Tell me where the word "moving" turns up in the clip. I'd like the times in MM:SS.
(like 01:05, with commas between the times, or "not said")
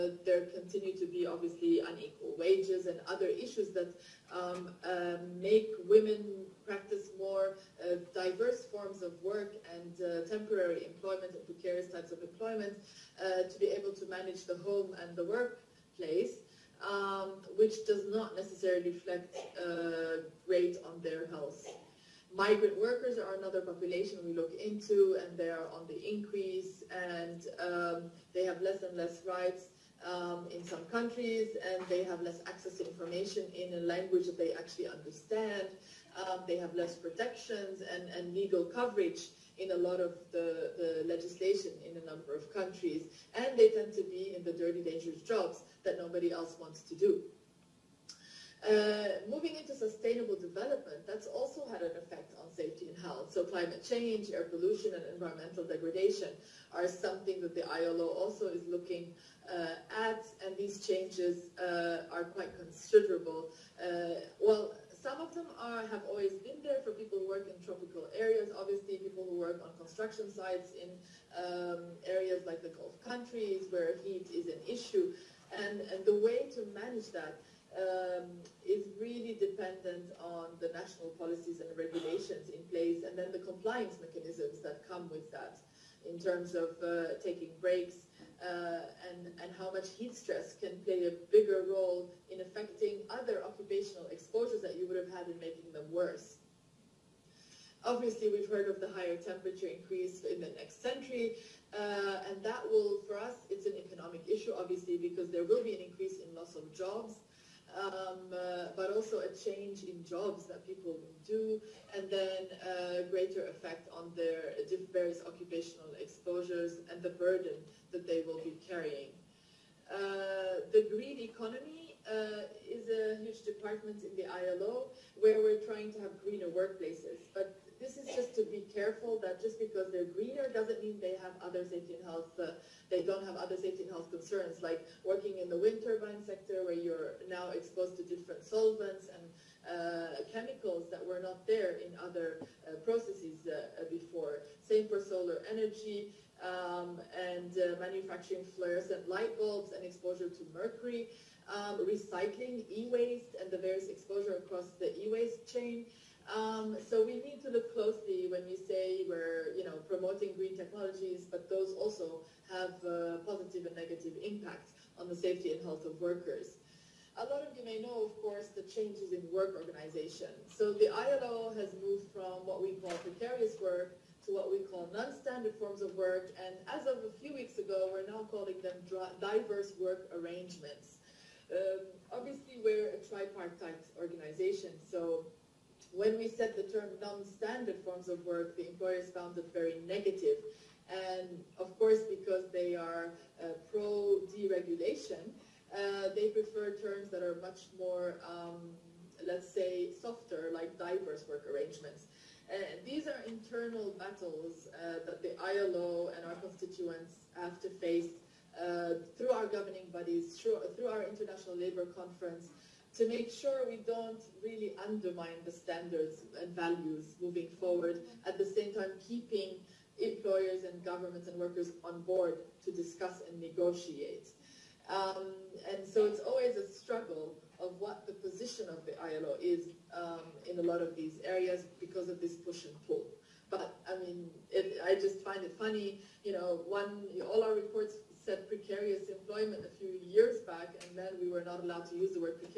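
00:49, 03:37.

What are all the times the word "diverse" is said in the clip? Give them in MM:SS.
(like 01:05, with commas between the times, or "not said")
02:59, 03:20.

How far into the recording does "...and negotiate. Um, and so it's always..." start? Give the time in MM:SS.
03:43.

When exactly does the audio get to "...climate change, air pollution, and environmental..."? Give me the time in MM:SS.
00:53.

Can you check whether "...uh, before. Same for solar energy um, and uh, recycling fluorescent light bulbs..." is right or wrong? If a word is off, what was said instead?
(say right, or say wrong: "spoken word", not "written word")
wrong: "manufacturing", not "recycling".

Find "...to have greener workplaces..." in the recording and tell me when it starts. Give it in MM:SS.
02:05.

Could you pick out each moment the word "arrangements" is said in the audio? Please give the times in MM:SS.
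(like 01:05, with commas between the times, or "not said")
03:00, 03:21.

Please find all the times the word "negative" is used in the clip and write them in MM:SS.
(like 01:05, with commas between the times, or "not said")
02:43, 03:09.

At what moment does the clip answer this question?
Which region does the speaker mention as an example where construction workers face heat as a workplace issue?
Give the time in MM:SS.
01:12.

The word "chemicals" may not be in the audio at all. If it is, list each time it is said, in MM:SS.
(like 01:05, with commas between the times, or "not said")
02:20.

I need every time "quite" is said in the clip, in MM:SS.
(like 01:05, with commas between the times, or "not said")
01:02.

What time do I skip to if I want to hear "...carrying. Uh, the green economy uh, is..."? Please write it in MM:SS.
01:58.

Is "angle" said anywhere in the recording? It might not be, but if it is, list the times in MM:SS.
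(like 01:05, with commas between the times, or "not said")
not said.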